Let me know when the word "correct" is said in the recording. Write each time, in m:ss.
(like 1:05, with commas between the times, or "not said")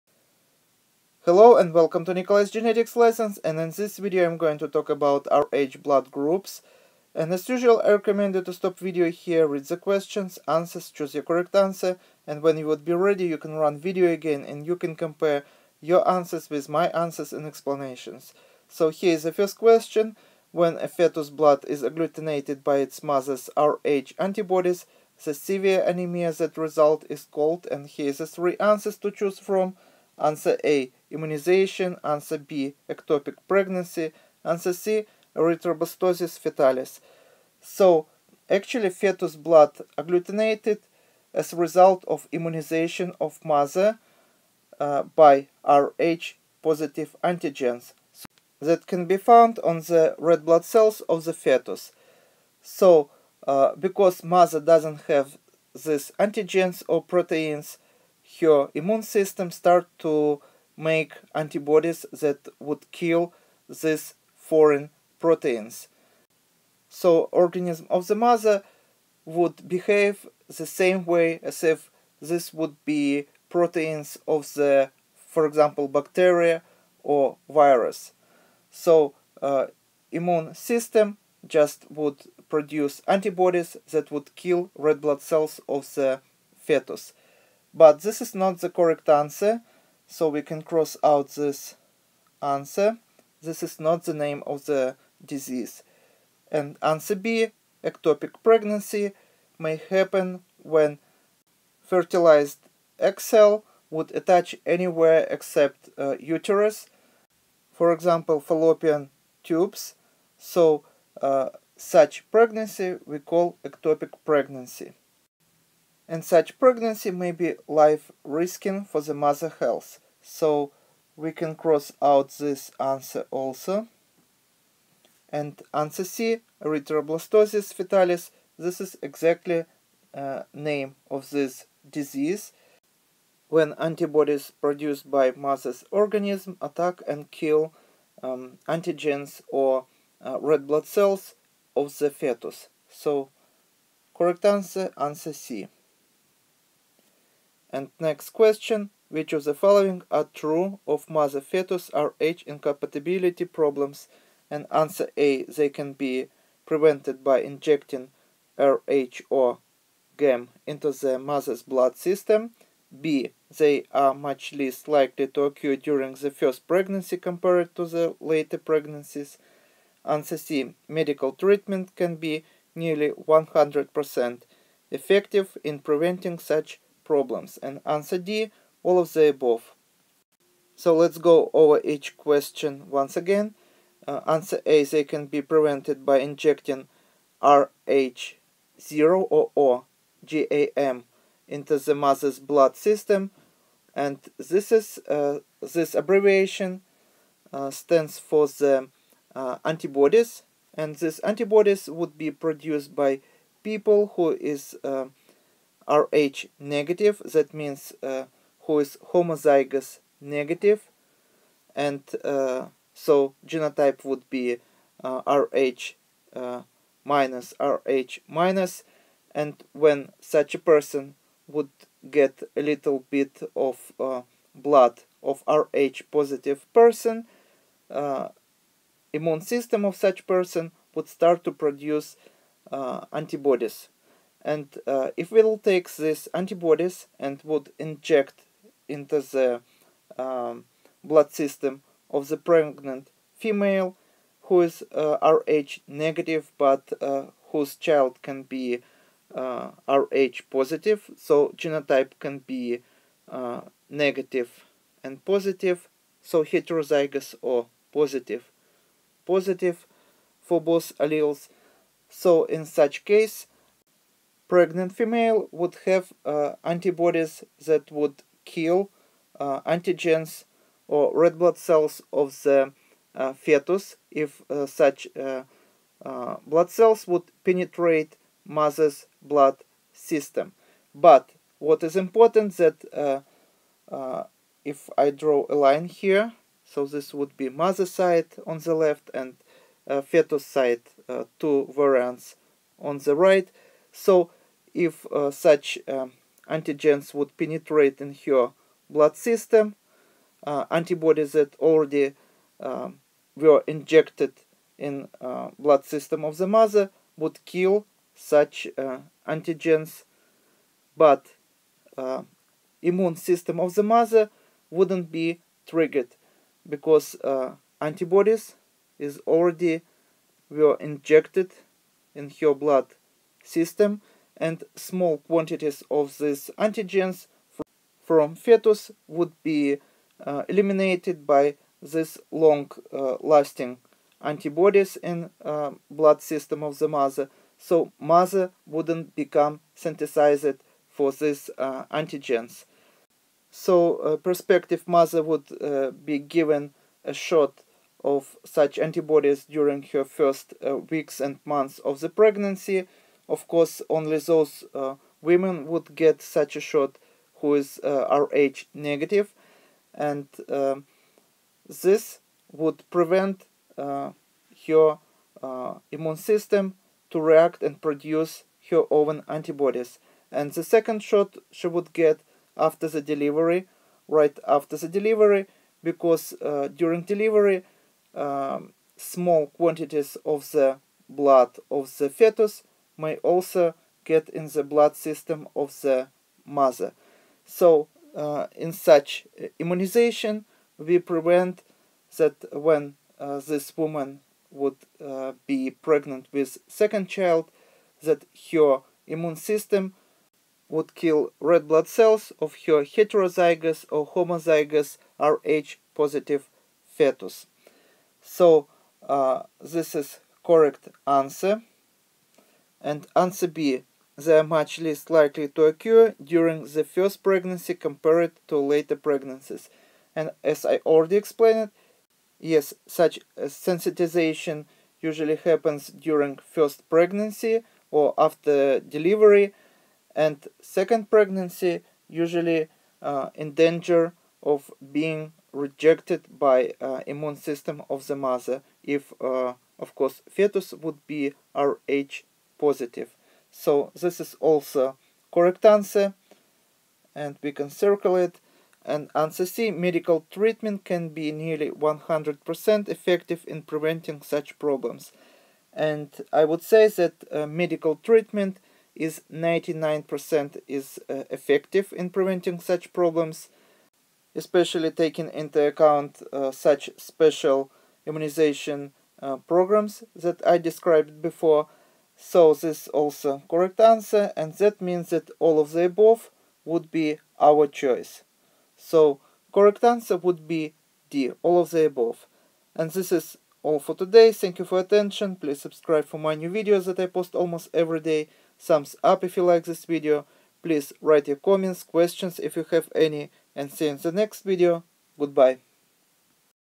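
0:11, 1:28, 2:24, 6:50, 7:25, 7:53, 7:59.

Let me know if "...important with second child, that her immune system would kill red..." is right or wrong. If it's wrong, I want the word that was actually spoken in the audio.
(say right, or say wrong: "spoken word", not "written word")
wrong: "pregnant", not "important".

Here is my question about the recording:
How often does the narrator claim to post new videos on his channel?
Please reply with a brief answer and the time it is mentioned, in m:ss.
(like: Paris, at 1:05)
Almost every day, at 8:07.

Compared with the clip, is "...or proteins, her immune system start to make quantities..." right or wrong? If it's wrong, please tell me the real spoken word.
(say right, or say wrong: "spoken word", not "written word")
wrong: "antibodies", not "quantities".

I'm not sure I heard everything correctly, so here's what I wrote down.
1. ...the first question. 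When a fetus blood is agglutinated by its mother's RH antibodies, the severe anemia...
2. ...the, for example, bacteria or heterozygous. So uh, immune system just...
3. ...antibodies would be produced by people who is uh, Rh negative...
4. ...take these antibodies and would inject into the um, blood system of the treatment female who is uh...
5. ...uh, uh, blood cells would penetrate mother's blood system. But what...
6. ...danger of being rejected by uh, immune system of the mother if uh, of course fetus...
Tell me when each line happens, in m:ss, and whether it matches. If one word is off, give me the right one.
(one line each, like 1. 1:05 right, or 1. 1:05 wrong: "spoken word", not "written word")
1. 0:19 right
2. 1:14 wrong: "virus", not "heterozygous"
3. 3:21 right
4. 3:55 wrong: "pregnant", not "treatment"
5. 4:35 right
6. 7:13 right.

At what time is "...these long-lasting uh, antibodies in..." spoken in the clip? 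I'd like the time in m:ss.
5:31.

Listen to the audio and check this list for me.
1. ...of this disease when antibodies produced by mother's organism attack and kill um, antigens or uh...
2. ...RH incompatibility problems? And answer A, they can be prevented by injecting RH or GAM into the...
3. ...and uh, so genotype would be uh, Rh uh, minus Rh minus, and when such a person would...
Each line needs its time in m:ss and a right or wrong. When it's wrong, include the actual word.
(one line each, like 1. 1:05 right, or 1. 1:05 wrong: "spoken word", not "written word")
1. 2:11 right
2. 2:31 right
3. 3:31 right.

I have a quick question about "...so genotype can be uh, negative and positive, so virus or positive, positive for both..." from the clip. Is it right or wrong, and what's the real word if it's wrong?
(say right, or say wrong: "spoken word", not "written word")
wrong: "heterozygous", not "virus".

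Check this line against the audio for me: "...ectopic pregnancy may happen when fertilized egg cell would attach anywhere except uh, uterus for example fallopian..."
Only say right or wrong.
right.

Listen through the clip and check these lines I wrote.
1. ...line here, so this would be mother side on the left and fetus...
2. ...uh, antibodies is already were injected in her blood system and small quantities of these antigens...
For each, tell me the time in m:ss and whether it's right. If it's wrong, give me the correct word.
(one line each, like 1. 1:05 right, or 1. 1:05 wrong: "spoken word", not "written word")
1. 4:45 right
2. 5:17 right.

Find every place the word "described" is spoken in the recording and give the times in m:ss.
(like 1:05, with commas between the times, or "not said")
7:50.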